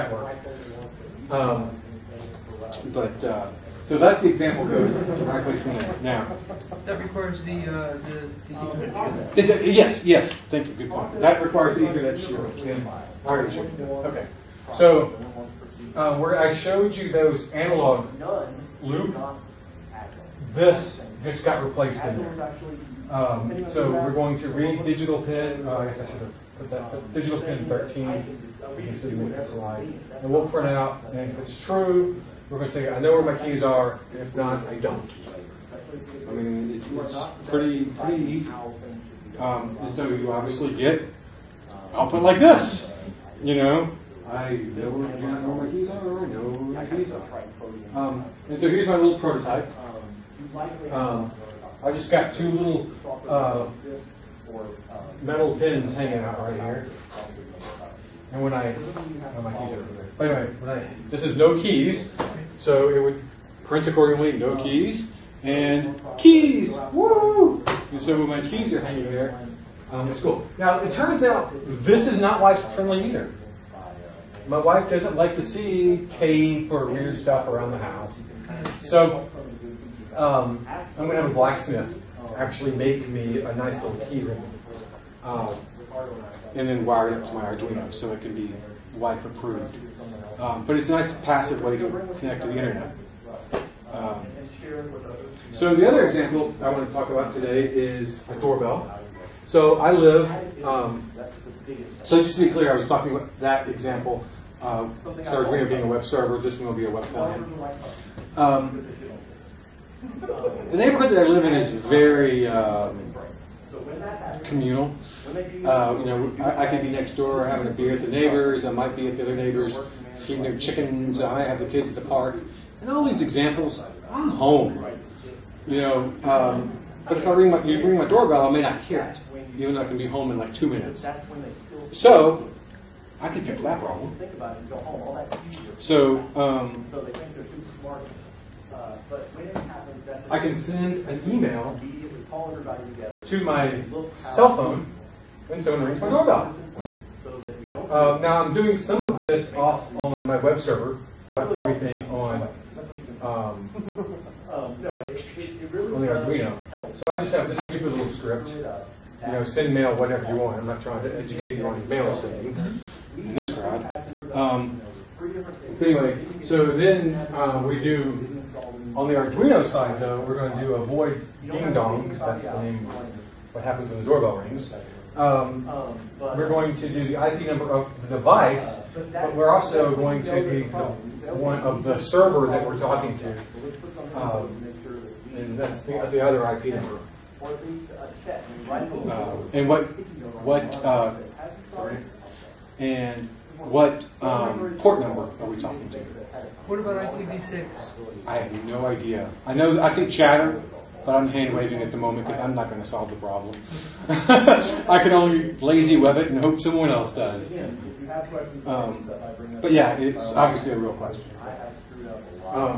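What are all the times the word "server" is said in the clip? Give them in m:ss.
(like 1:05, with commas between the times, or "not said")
1:46, 2:30, 3:01.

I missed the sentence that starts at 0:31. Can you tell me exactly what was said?
And if it's true, we're going to say, I know where my keys are, and if not, I don't.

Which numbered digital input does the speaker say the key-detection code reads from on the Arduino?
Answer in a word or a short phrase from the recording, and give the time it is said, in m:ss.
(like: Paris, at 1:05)
13, at 0:27.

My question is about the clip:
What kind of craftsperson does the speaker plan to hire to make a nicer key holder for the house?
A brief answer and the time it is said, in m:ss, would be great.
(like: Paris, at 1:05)
Blacksmith, at 1:21.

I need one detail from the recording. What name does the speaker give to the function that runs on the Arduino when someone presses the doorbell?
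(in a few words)
ding dong.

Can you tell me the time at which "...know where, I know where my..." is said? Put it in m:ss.
0:44.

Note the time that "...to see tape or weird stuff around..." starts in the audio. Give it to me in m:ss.
1:15.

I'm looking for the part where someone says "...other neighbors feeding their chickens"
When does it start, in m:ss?
1:59.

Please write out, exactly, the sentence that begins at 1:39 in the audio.
So I live, um, so just to be clear, I was talking about that example.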